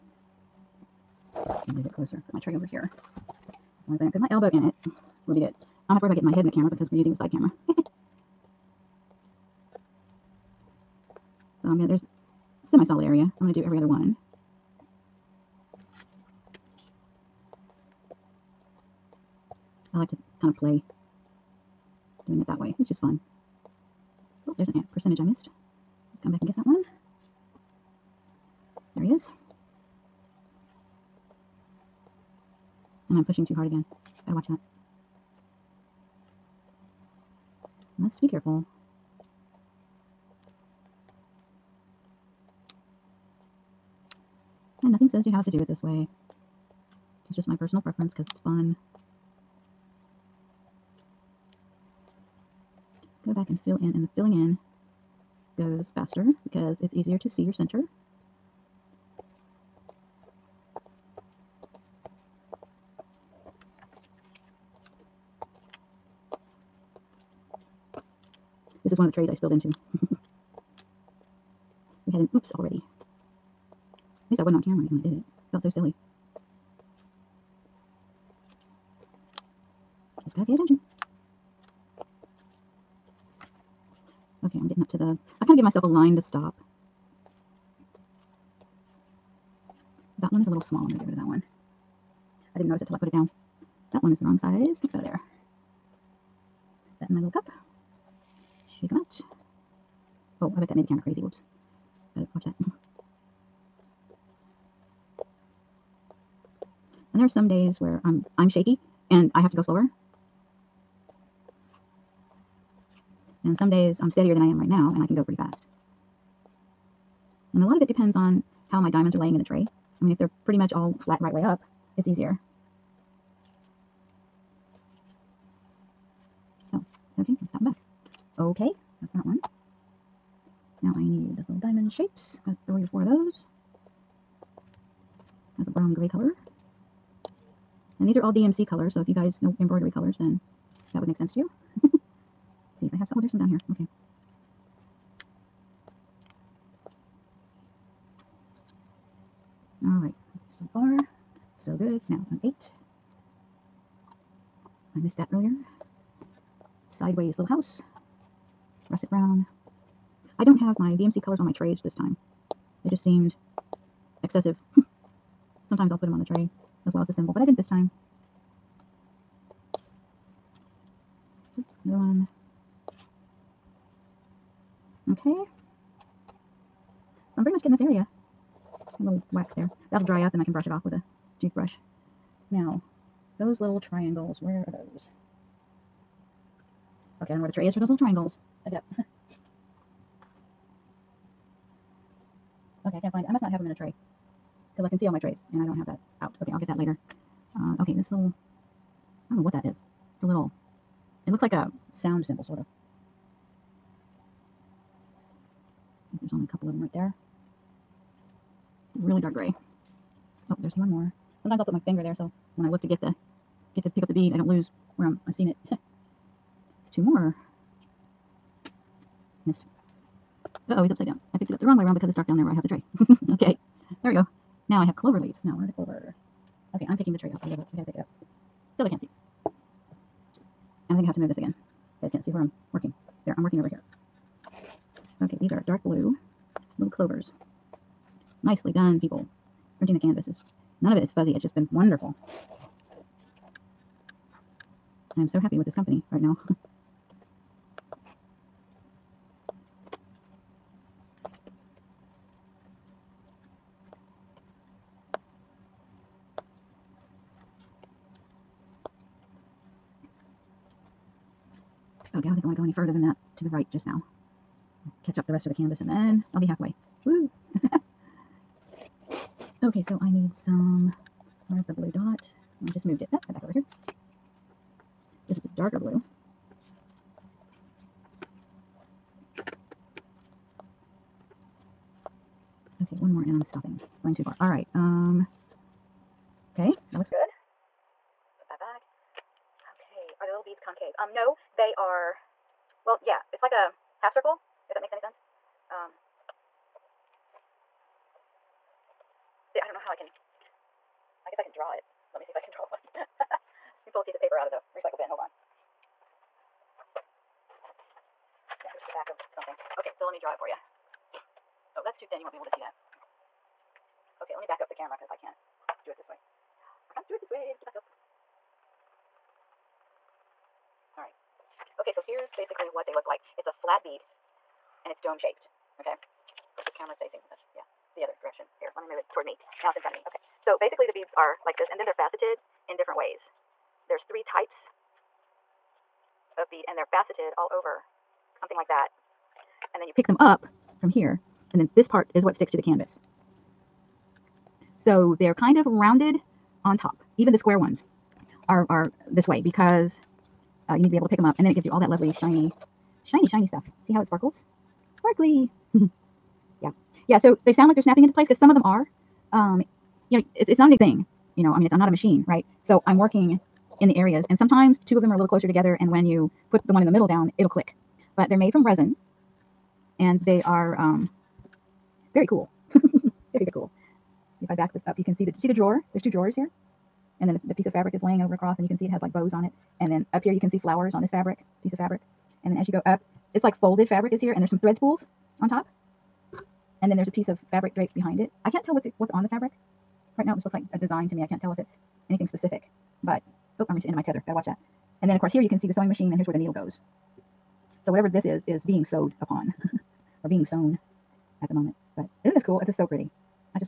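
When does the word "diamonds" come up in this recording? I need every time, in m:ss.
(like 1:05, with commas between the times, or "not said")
1:58, 2:11.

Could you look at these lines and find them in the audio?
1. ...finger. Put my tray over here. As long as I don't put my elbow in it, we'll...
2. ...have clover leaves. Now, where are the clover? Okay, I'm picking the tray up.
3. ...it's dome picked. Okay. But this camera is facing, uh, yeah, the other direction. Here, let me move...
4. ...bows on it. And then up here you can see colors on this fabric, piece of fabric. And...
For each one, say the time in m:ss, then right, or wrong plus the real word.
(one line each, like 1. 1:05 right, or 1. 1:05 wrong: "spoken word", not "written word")
1. 0:01 wrong: "closer", not "finger"
2. 3:44 right
3. 5:24 wrong: "shaped", not "picked"
4. 6:19 wrong: "flowers", not "colors".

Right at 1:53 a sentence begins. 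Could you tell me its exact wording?
And some days I'm steadier than I am right now and I can go pretty fast.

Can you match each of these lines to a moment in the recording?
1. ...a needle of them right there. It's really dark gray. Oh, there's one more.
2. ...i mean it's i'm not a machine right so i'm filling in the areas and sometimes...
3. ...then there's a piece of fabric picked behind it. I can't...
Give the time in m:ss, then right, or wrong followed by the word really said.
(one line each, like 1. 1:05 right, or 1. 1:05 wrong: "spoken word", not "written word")
1. 3:26 wrong: "couple", not "needle"
2. 6:01 wrong: "working", not "filling"
3. 6:26 wrong: "draped", not "picked".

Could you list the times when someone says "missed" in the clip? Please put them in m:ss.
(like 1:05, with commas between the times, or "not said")
0:25, 2:34, 3:39.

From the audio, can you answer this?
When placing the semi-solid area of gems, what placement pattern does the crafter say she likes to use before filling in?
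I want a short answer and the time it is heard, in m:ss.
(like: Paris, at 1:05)
Every other one, at 0:13.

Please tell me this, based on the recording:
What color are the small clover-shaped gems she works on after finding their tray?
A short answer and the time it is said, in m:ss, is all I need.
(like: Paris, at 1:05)
Dark blue, at 3:55.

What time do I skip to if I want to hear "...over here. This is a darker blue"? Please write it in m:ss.
4:33.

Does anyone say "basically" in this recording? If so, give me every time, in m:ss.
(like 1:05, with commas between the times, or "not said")
5:22, 5:30.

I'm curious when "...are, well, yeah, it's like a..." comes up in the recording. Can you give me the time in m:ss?
4:51.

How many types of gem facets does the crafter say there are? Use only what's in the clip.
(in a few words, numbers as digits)
3.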